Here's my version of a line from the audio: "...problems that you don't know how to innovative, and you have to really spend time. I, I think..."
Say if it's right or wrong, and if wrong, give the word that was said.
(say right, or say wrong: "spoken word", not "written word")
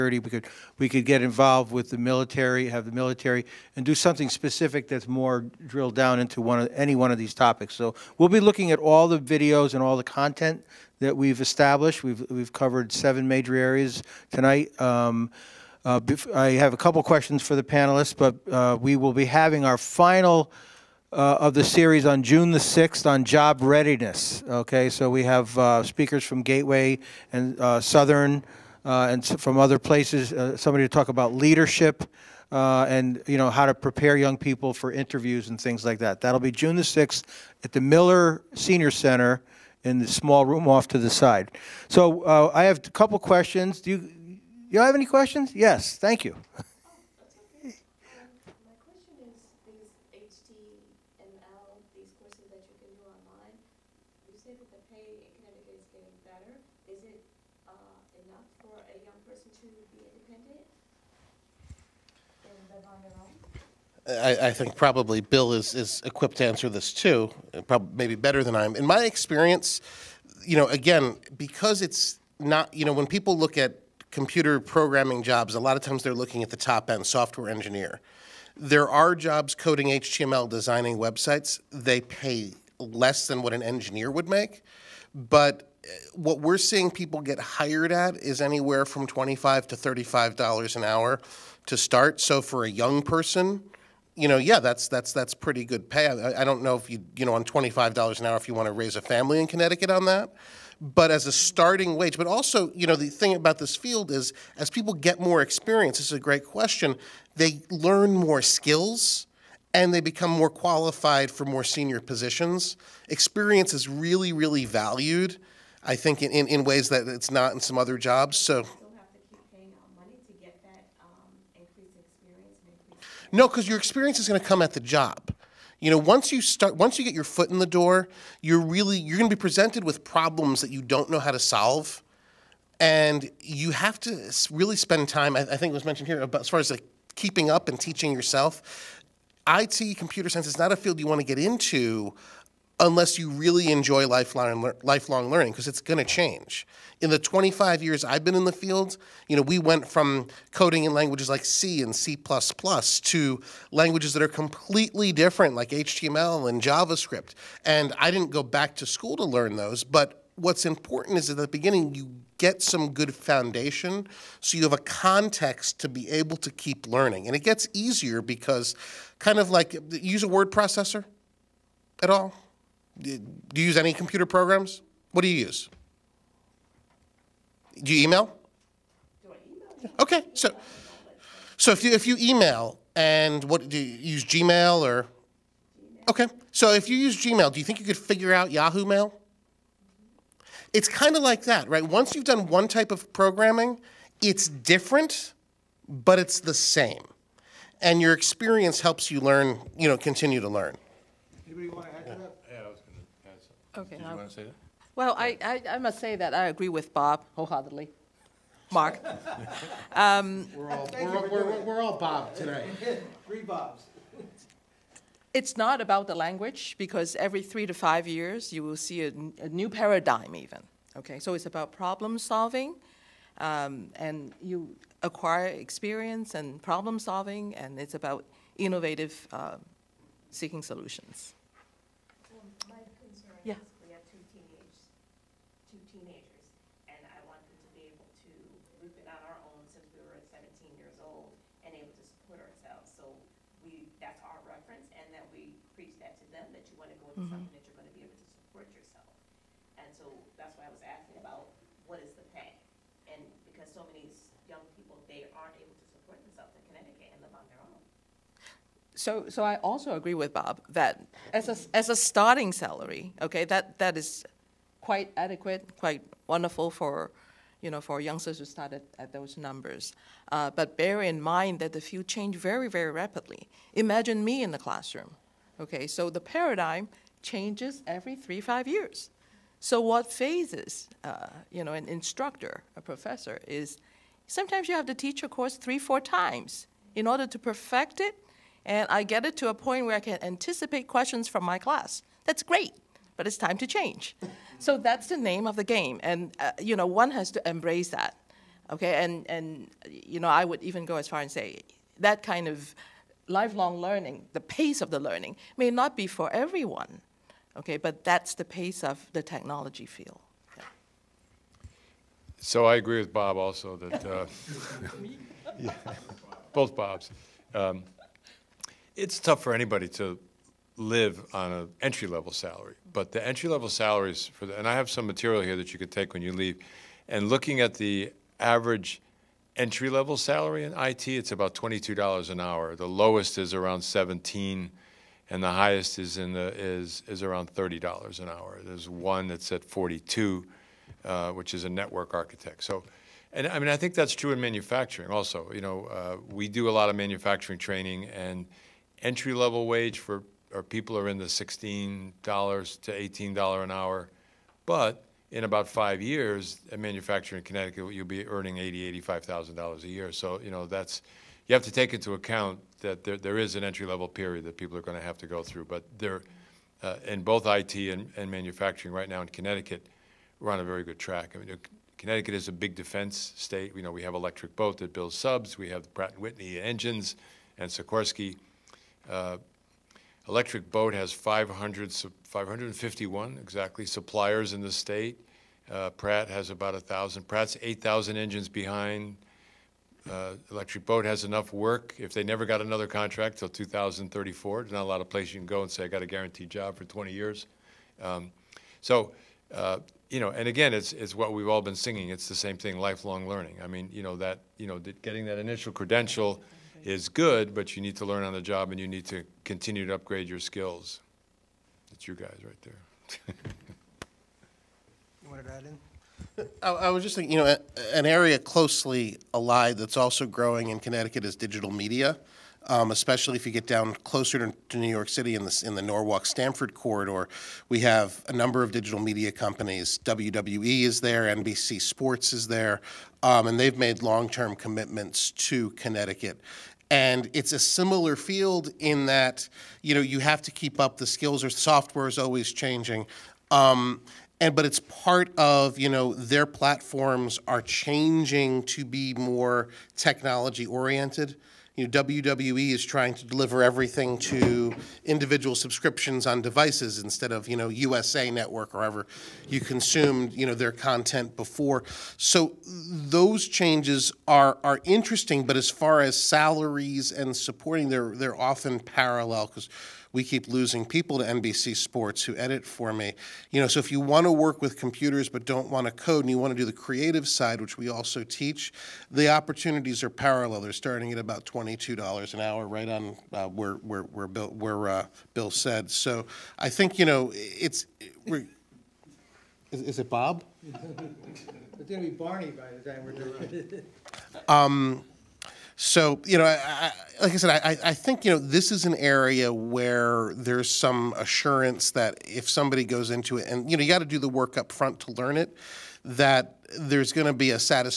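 wrong: "solve", not "innovative".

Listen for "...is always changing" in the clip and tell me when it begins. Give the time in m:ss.
7:22.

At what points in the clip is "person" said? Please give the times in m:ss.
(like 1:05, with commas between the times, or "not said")
0:59, 1:33.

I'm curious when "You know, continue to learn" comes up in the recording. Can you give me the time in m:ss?
3:19.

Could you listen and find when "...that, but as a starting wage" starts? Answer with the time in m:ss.
1:40.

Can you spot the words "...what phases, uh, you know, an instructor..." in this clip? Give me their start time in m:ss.
4:39.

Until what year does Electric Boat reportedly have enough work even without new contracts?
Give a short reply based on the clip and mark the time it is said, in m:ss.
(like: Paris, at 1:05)
2034, at 6:33.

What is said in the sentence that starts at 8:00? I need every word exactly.
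They're starting at about $22 an hour, right on uh, where, where, where, Bill, where uh, Bill said.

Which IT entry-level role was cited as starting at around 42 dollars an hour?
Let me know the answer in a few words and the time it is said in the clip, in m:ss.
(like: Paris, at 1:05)
Network architect, at 5:41.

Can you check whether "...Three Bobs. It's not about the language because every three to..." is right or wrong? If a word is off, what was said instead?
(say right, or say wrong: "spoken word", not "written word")
right.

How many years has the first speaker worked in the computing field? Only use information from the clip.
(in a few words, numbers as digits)
25 years.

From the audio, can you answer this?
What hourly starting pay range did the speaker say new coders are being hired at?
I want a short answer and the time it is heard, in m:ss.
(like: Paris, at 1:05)
$25 to $35 an hour, at 1:29.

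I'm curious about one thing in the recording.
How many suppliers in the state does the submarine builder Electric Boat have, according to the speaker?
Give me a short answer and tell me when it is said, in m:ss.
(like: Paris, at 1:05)
551, at 6:22.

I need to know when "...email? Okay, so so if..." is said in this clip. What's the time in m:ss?
2:59.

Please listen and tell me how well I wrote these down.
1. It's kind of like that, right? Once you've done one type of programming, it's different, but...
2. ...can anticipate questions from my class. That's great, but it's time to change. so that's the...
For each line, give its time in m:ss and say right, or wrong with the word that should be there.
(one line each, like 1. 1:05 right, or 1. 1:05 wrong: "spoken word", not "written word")
1. 3:10 right
2. 4:49 right.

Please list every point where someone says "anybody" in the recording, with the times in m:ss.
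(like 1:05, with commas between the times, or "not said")
5:19.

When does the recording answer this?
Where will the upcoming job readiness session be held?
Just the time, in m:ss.
0:37.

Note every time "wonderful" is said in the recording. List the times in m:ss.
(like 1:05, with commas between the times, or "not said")
4:26.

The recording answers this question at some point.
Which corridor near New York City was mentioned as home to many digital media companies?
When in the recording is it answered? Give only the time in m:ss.
7:05.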